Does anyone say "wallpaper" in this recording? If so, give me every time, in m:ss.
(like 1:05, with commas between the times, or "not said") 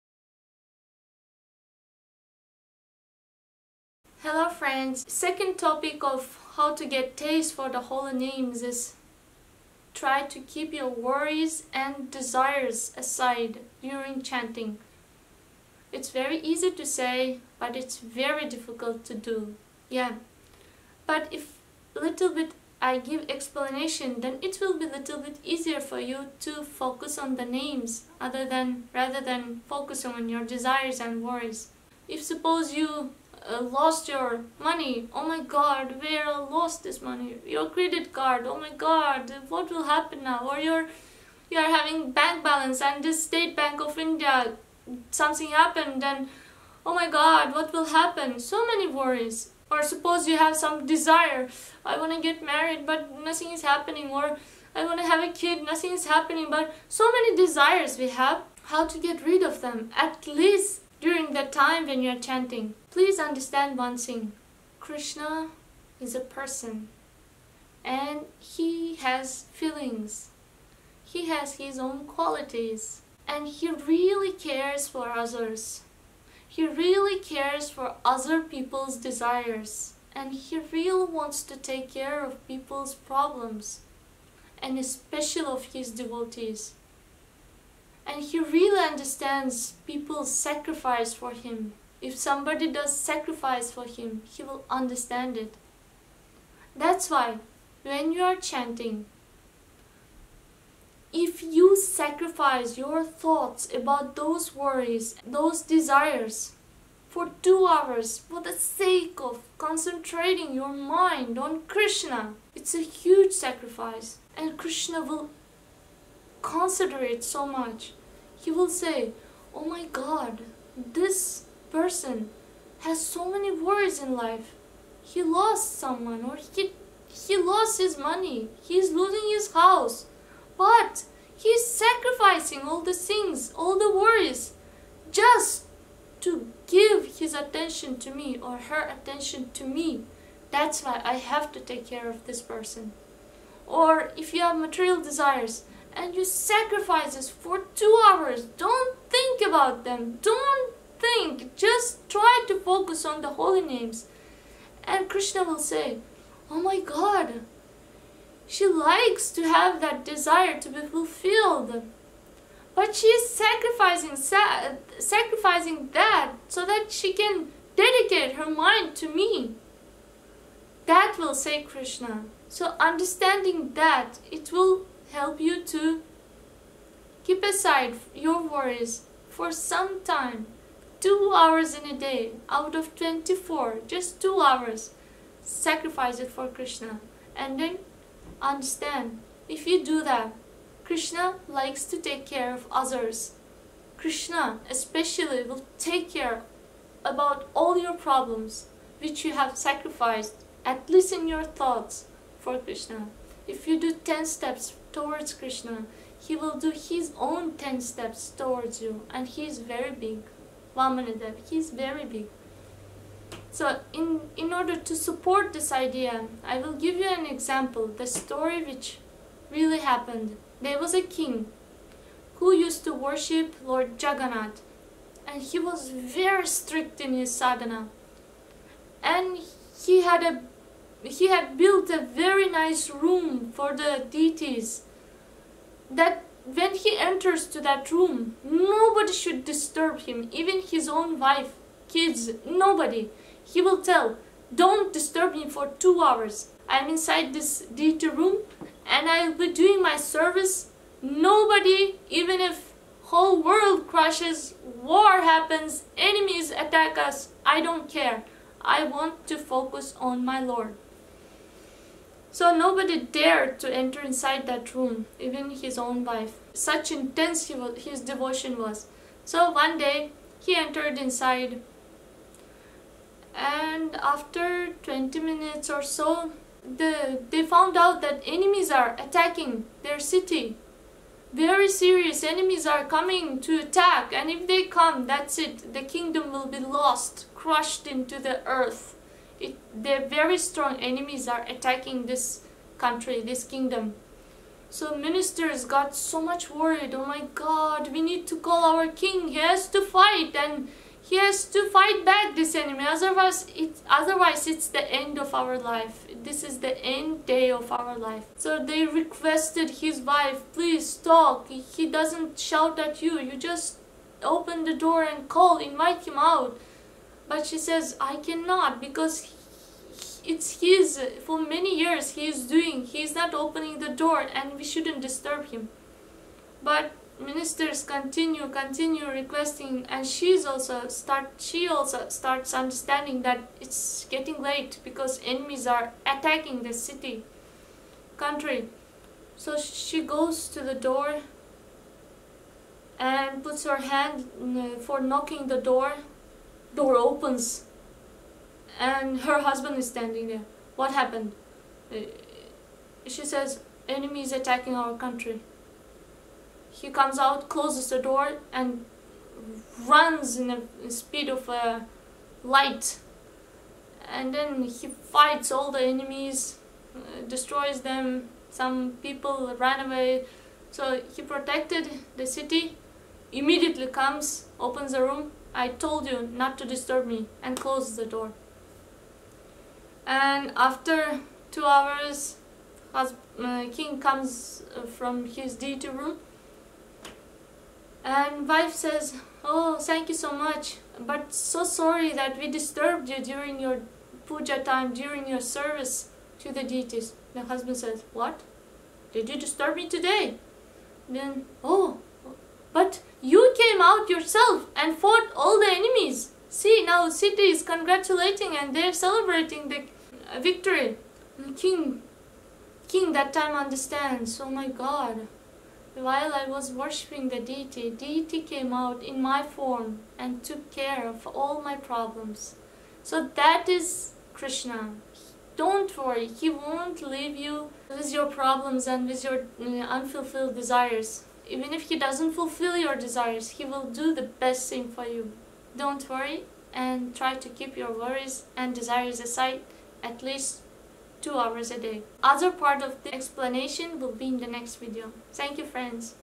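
not said.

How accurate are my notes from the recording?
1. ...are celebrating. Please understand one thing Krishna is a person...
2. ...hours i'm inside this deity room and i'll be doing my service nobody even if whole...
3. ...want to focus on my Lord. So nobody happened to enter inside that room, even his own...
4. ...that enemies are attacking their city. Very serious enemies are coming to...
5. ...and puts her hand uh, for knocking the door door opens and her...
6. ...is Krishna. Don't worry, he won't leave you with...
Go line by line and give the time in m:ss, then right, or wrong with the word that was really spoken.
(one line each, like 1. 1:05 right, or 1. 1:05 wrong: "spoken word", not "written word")
1. 1:02 wrong: "chanting", not "celebrating"
2. 4:06 right
3. 4:18 wrong: "dared", not "happened"
4. 4:38 right
5. 5:42 right
6. 7:03 right.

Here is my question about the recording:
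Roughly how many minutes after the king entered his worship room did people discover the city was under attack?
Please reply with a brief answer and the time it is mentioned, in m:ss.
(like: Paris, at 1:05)
20 minutes, at 4:34.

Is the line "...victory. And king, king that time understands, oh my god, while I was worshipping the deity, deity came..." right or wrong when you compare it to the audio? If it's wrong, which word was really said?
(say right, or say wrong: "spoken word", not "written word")
right.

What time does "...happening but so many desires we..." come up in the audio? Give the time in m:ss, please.
0:56.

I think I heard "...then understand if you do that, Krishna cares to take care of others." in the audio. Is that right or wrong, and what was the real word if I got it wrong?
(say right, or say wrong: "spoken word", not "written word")
wrong: "likes", not "cares".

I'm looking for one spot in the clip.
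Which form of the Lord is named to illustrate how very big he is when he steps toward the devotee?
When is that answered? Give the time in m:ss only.
3:30.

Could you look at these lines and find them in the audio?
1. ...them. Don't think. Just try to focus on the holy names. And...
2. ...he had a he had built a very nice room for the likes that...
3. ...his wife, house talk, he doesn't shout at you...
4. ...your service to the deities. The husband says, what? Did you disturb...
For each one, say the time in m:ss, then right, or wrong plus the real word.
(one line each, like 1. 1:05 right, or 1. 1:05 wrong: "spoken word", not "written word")
1. 2:29 right
2. 3:49 wrong: "deities", not "likes"
3. 5:09 wrong: "please", not "house"
4. 6:35 right.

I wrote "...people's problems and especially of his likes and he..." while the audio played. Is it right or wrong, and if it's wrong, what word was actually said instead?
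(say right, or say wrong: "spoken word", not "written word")
wrong: "devotees", not "likes".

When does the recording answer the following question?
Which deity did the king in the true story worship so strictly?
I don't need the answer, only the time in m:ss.
3:43.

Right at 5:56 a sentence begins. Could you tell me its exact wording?
He comes out, closes the door and runs in the speed of a uh, light.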